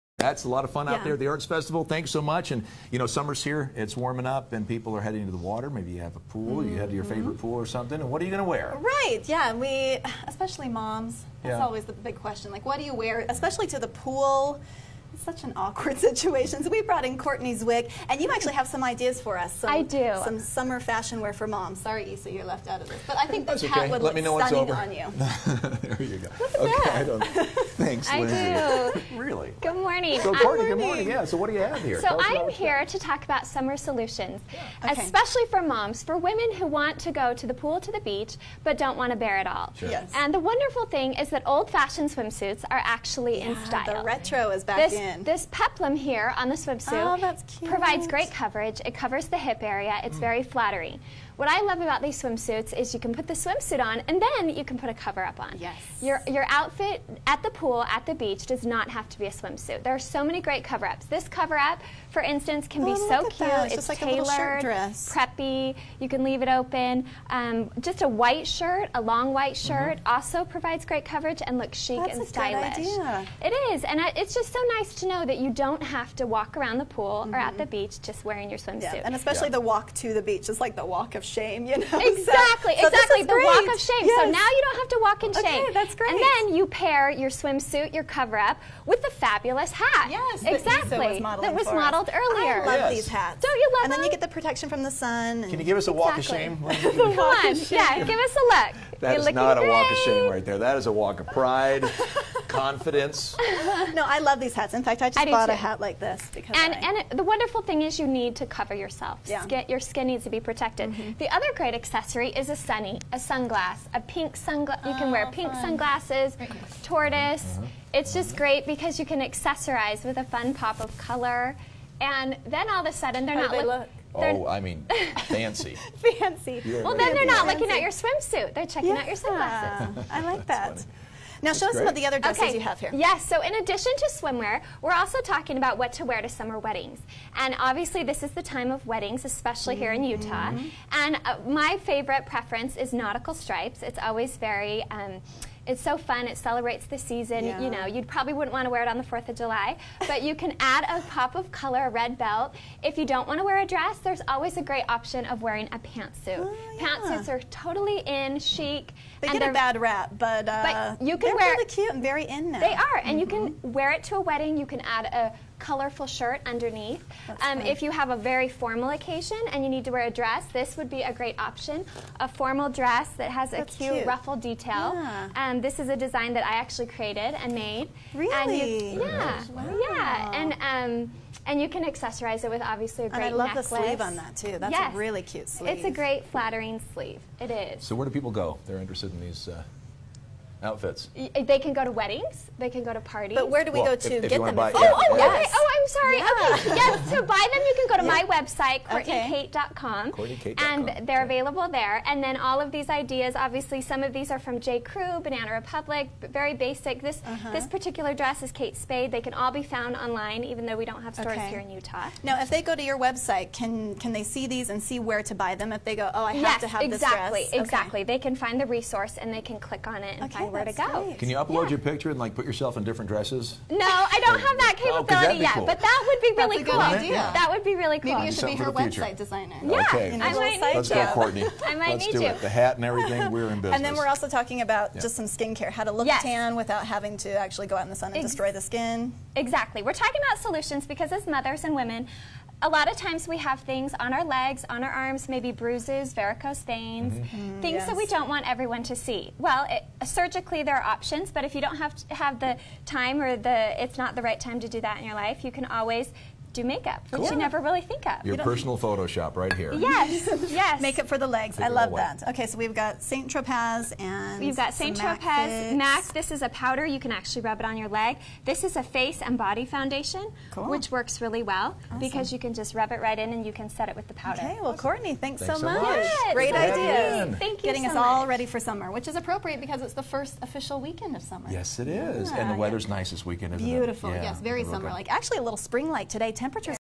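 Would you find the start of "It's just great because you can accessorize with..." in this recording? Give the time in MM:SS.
01:57.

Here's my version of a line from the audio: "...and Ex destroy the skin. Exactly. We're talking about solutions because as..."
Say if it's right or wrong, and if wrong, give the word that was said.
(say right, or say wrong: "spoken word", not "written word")
right.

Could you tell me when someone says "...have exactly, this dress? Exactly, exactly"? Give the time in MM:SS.
03:36.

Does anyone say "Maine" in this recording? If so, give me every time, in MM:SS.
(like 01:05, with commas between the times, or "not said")
not said.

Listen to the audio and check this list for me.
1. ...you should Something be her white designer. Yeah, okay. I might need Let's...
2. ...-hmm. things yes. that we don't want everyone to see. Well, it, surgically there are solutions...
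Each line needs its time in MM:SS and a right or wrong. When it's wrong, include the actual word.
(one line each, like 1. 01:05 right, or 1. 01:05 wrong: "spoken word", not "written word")
1. 03:48 wrong: "website", not "white"
2. 04:07 wrong: "options", not "solutions".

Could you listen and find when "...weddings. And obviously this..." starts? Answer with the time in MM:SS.
02:16.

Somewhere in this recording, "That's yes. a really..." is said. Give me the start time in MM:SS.
03:04.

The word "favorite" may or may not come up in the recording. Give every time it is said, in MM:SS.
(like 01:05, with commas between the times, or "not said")
00:07, 02:21.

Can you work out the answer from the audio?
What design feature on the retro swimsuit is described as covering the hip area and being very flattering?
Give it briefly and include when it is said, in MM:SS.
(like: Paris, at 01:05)
Peplum, at 00:45.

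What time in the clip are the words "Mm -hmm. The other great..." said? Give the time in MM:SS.
01:50.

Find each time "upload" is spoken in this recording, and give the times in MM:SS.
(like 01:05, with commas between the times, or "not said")
03:41.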